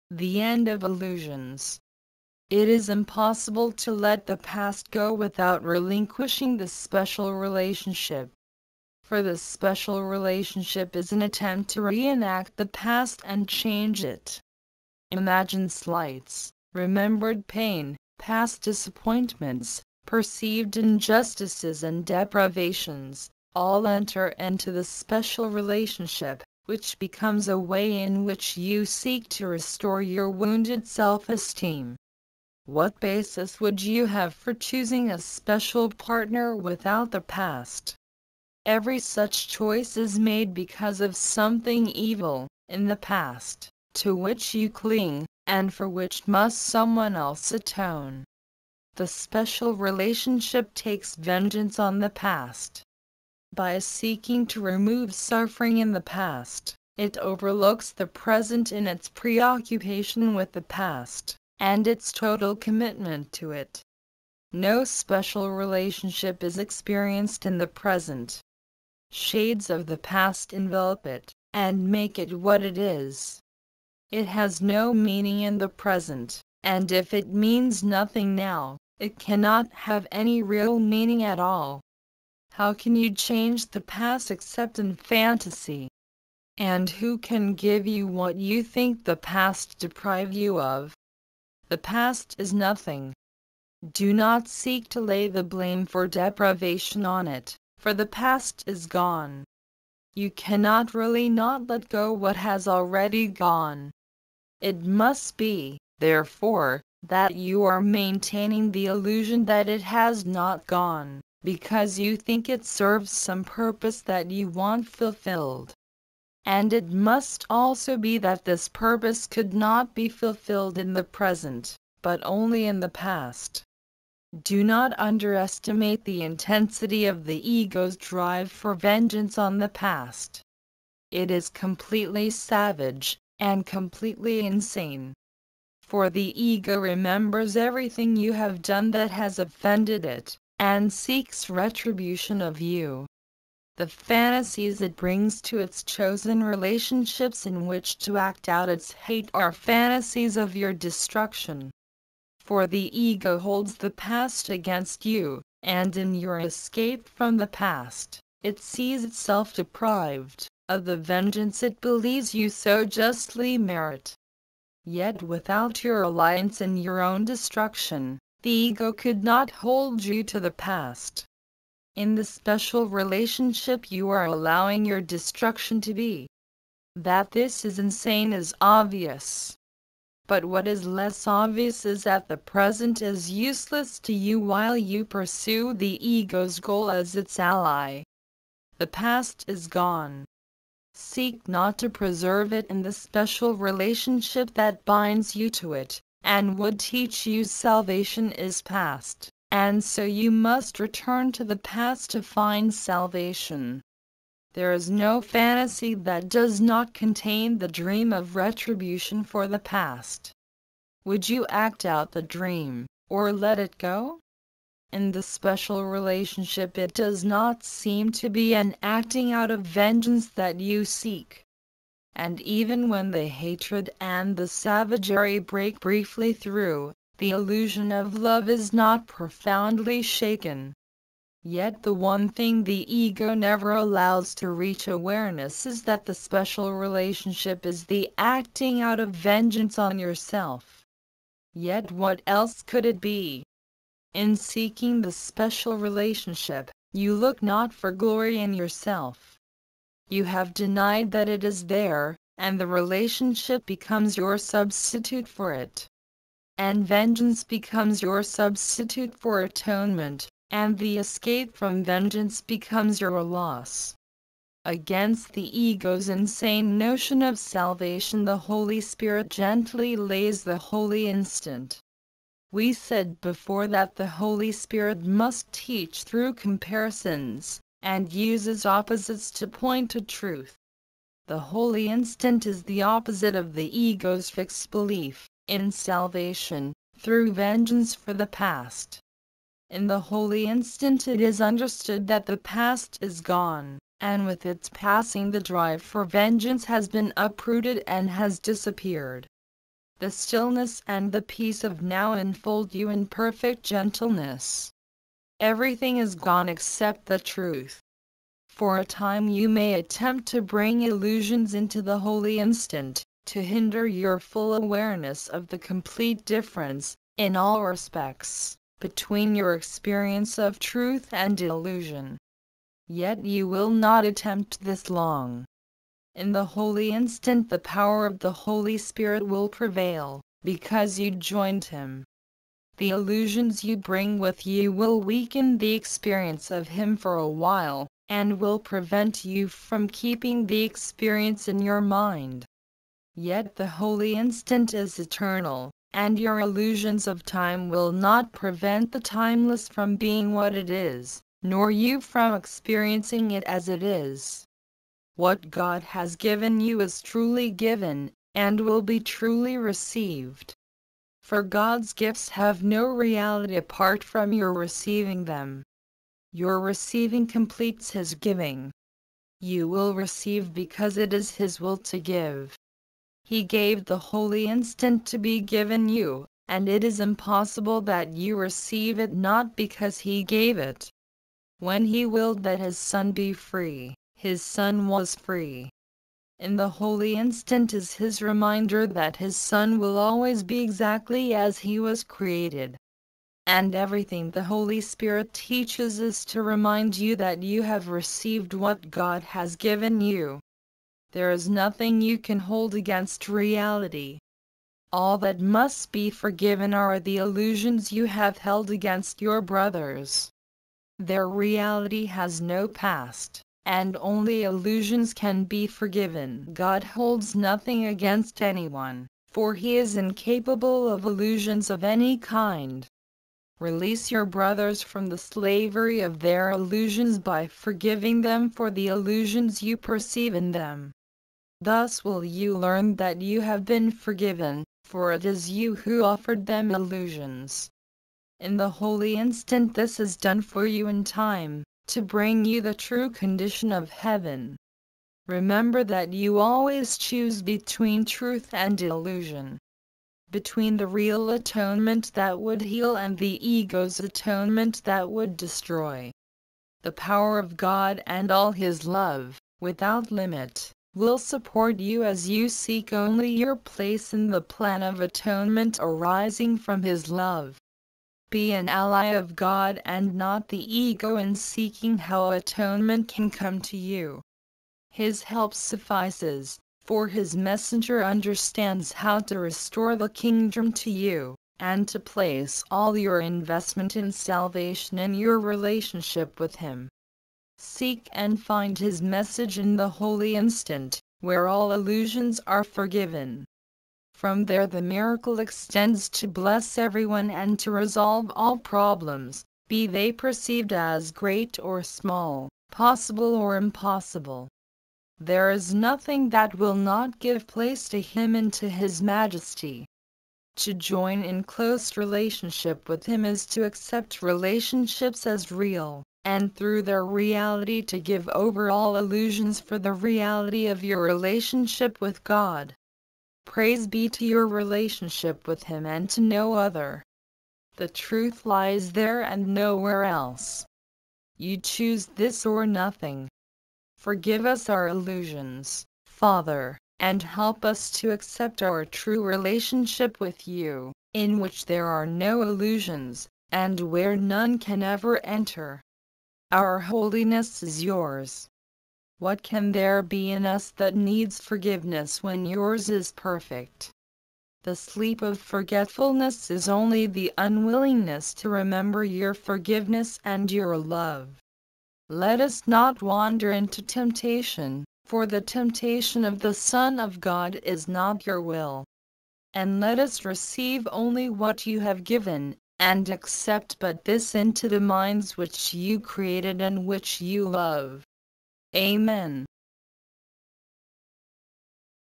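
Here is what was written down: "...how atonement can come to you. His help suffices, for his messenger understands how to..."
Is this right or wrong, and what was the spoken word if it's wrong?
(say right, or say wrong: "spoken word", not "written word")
right.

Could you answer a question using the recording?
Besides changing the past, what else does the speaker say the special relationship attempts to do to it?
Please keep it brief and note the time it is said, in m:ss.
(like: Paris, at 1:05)
reenact, at 0:11.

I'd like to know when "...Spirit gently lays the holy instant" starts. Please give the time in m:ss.
4:28.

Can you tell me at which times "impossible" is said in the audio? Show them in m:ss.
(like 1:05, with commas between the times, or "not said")
0:02, 6:16, 8:23.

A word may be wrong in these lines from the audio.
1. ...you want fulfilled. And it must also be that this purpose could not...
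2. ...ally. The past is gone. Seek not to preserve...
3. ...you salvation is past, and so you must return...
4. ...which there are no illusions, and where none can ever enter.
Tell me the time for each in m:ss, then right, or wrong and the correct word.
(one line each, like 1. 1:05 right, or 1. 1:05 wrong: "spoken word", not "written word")
1. 1:54 right
2. 3:07 right
3. 3:17 right
4. 9:01 right.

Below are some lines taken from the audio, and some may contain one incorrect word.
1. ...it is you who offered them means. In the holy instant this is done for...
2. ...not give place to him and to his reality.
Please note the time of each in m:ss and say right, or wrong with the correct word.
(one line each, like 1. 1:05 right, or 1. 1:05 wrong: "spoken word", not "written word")
1. 7:15 wrong: "illusions", not "means"
2. 8:26 wrong: "majesty", not "reality".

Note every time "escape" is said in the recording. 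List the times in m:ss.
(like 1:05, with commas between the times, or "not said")
2:36, 4:20.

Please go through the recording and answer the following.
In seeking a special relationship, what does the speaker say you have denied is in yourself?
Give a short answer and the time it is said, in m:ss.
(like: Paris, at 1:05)
glory, at 4:07.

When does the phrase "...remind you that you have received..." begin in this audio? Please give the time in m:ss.
6:36.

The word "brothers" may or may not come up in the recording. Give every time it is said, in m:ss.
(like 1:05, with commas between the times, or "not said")
6:49, 7:04.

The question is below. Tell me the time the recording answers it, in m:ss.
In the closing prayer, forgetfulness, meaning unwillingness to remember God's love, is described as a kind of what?
9:14.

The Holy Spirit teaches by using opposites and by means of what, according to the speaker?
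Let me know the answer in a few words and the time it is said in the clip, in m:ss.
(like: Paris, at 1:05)
comparisons, at 4:36.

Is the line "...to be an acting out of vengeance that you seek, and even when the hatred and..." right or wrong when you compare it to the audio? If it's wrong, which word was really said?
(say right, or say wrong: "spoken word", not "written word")
right.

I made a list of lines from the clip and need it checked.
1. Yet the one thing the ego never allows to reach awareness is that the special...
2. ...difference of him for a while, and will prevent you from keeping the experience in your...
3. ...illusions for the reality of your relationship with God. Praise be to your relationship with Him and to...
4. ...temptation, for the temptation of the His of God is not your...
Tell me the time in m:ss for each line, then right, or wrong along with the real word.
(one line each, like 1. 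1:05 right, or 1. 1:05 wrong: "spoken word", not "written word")
1. 3:51 right
2. 5:35 wrong: "experience", not "difference"
3. 8:38 right
4. 9:23 wrong: "Son", not "His".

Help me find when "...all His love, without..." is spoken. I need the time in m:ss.
7:38.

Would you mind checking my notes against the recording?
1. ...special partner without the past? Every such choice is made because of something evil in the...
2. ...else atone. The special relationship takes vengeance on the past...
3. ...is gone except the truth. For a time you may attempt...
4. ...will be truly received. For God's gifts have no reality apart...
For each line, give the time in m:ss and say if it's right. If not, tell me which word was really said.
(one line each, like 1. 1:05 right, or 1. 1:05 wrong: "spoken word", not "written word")
1. 0:35 right
2. 0:47 right
3. 5:05 right
4. 5:58 right.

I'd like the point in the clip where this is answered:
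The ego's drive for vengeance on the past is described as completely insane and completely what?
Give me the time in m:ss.
2:12.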